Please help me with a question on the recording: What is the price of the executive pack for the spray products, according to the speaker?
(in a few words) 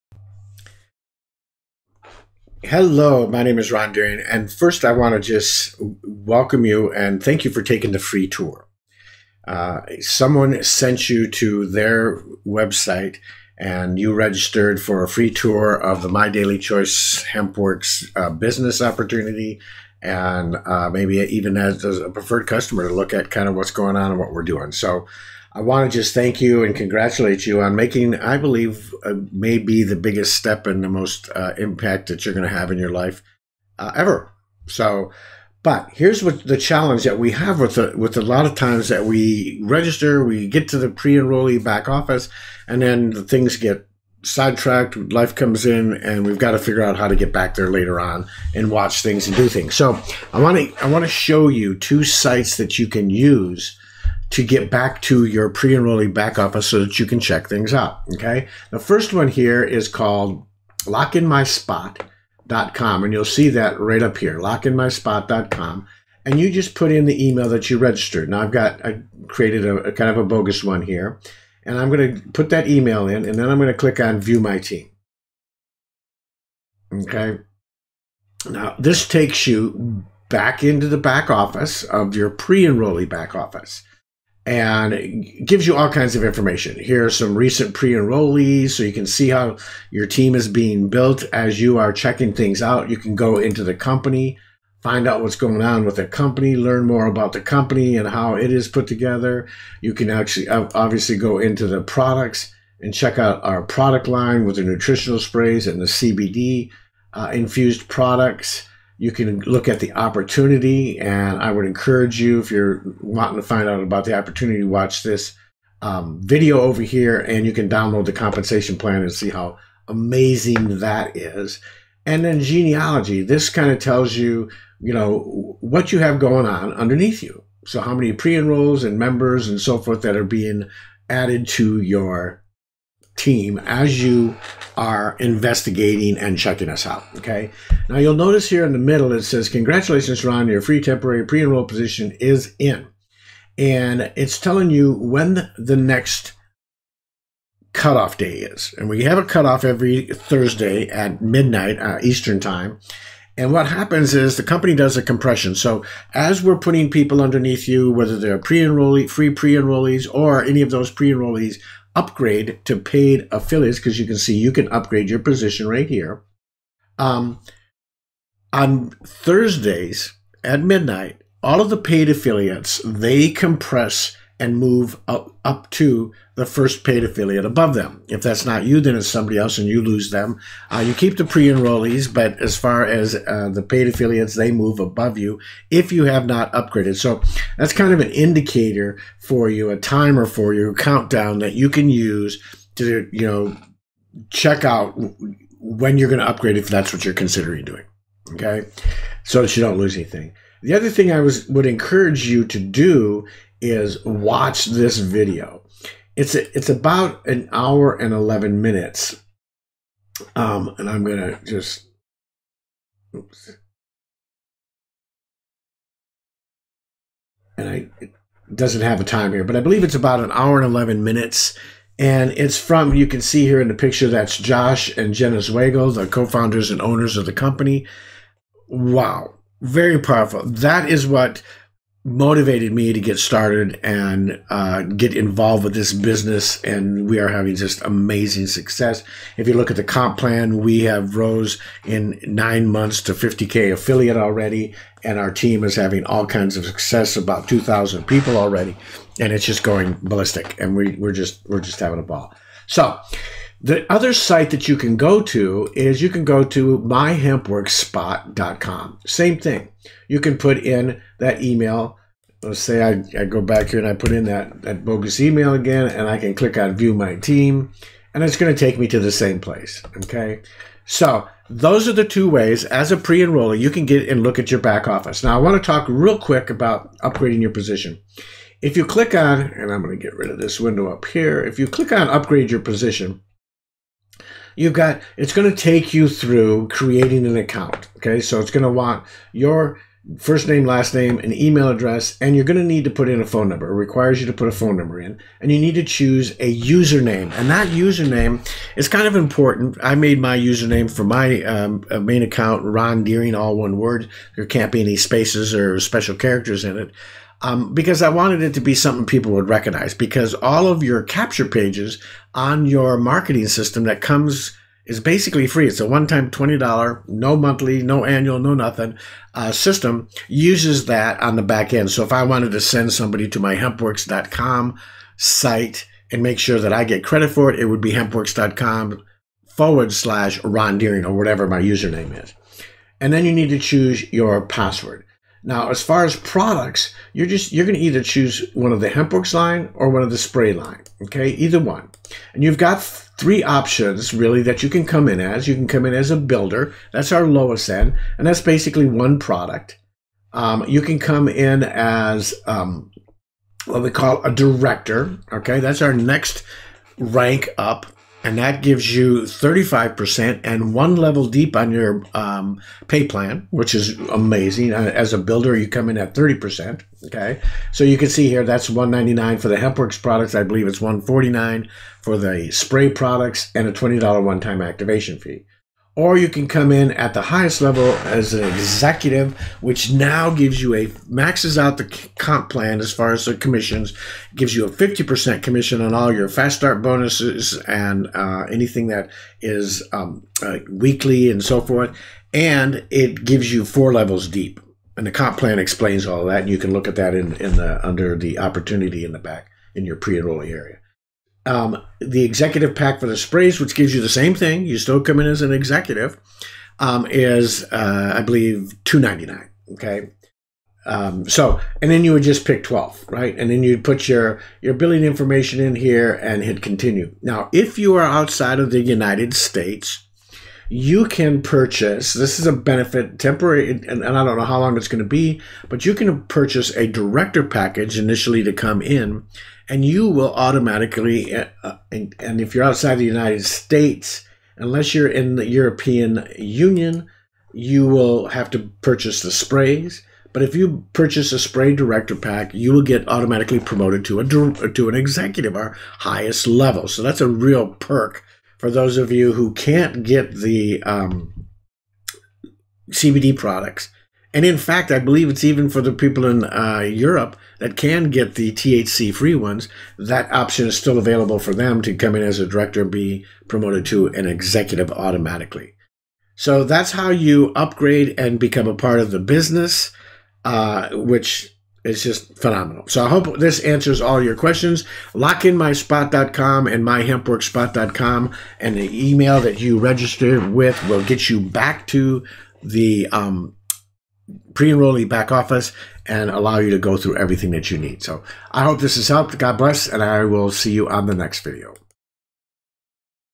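$299.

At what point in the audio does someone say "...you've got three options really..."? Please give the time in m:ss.
5:42.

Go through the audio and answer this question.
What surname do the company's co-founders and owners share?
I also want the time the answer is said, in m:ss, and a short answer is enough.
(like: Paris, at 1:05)
Zwagil, at 3:45.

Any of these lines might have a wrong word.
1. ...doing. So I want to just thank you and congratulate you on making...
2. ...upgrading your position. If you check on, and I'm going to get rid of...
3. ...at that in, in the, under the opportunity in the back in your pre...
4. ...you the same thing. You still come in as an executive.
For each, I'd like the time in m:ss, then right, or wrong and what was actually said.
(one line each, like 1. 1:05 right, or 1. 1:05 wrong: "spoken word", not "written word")
1. 0:24 right
2. 4:37 wrong: "click", not "check"
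3. 6:36 right
4. 6:43 right.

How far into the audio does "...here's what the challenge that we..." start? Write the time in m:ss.
0:35.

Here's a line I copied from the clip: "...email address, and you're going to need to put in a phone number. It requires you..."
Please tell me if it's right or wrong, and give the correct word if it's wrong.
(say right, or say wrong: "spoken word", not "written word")
right.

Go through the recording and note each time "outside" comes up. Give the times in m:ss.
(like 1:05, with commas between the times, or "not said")
6:58, 7:12.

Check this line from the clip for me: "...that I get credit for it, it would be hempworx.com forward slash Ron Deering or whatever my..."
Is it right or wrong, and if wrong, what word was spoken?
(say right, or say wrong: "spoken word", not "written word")
right.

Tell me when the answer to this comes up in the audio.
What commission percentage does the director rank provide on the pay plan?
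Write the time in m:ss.
5:59.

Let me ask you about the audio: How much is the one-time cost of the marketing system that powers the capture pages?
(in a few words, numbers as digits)
$20.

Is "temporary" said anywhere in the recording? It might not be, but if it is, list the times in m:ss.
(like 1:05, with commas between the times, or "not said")
2:20, 7:03.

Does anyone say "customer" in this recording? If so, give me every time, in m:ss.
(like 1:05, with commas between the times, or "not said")
0:22.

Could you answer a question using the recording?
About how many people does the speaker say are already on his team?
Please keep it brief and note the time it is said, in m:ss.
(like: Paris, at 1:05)
2,000, at 4:07.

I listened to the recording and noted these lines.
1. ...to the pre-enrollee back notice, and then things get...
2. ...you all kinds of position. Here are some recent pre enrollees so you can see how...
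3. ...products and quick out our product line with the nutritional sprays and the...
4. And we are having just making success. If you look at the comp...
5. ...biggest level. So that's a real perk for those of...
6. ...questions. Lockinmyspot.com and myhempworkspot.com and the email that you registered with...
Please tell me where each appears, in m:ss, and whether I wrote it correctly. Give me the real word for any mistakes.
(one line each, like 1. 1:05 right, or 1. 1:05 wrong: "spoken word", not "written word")
1. 0:40 wrong: "office", not "notice"
2. 1:25 wrong: "information", not "position"
3. 1:41 wrong: "check", not "quick"
4. 3:56 wrong: "amazing", not "making"
5. 7:25 wrong: "highest", not "biggest"
6. 7:54 right.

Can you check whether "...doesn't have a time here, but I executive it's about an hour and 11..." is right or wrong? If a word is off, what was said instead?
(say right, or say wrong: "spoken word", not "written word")
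wrong: "believe", not "executive".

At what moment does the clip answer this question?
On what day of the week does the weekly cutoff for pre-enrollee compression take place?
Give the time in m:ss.
2:29.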